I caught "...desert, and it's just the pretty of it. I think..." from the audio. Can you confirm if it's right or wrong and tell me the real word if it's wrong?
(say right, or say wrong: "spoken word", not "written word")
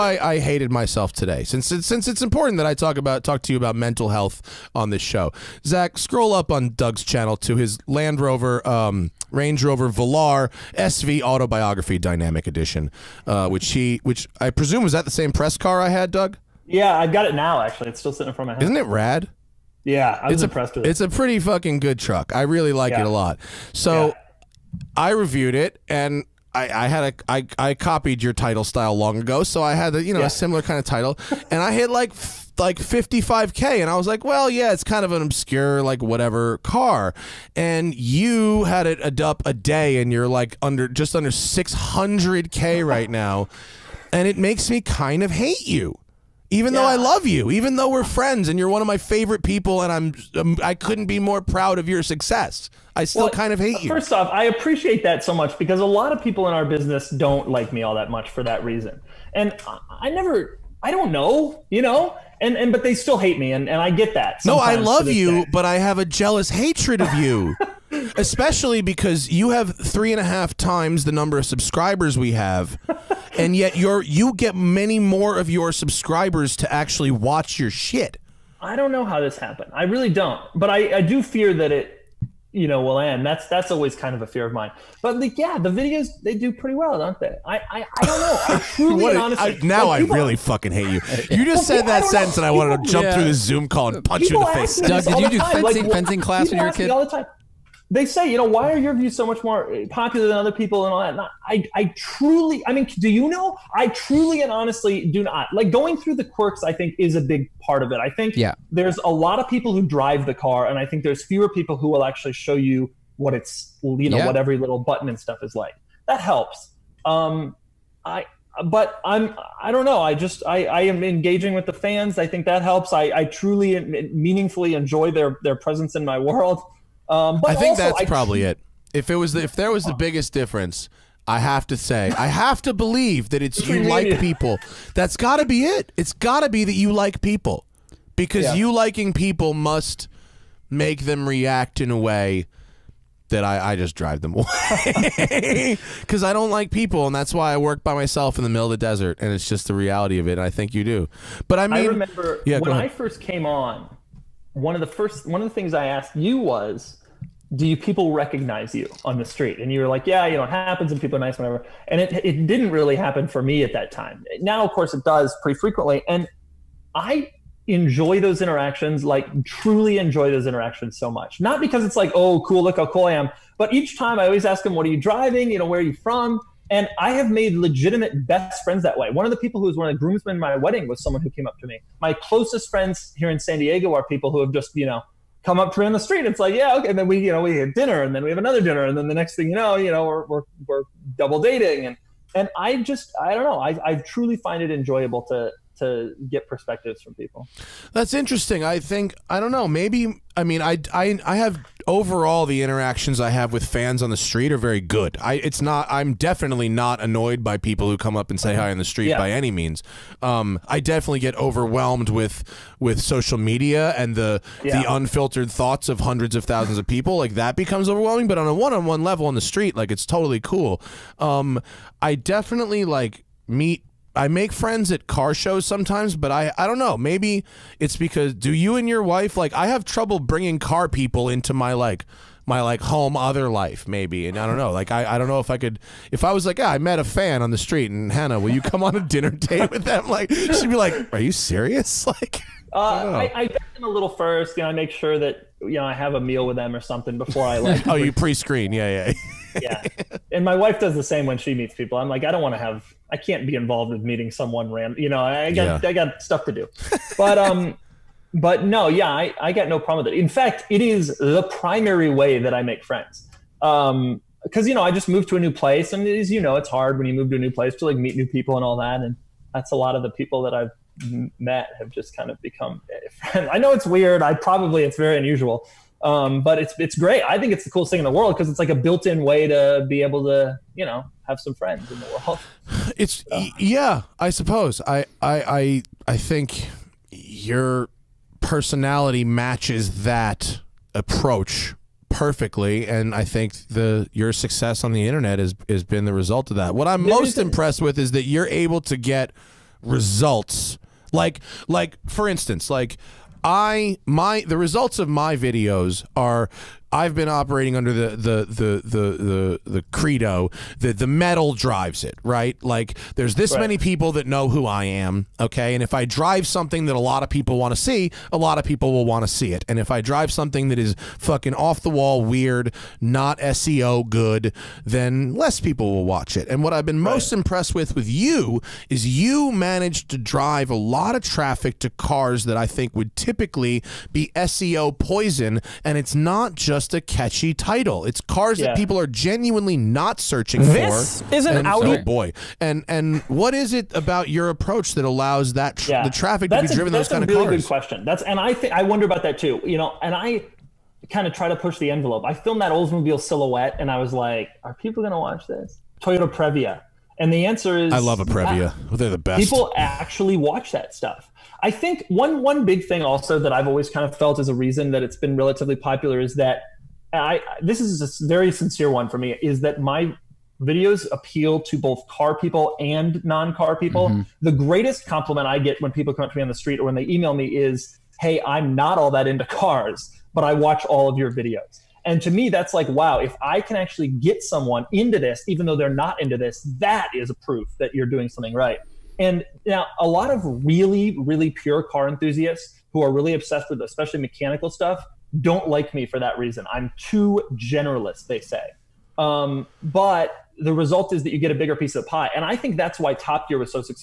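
wrong: "reality", not "pretty".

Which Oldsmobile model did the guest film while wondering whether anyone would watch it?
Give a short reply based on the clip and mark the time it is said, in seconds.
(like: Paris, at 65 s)
Silhouette, at 353 s.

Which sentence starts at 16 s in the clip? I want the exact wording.
Yeah, I've got it now actually.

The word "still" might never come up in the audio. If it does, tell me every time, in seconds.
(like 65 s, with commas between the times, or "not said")
17 s, 53 s, 62 s.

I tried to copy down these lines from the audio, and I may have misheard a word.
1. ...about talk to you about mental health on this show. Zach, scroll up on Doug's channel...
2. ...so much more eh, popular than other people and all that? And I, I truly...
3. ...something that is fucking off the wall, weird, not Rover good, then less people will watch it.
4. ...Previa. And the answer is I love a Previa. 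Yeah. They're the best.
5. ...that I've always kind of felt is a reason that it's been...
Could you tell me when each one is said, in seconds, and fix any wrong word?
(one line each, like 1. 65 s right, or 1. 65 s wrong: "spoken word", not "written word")
1. 2 s right
2. 99 s right
3. 320 s wrong: "SEO", not "Rover"
4. 356 s right
5. 363 s right.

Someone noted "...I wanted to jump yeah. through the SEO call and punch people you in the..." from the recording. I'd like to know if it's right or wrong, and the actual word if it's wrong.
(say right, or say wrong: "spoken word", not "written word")
wrong: "Zoom", not "SEO".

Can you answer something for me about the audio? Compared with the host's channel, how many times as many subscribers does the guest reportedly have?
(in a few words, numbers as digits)
three and a half.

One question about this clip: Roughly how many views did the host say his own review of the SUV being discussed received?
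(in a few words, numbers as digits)
55k.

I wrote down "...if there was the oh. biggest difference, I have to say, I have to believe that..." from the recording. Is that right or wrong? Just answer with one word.
right.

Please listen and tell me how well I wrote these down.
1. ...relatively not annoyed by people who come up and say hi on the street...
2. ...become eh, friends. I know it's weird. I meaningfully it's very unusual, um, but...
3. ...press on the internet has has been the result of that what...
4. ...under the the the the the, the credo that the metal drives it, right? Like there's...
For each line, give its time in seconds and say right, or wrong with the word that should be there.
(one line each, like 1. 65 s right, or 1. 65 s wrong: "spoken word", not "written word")
1. 206 s wrong: "definitely", not "relatively"
2. 272 s wrong: "probably", not "meaningfully"
3. 294 s wrong: "success", not "press"
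4. 307 s right.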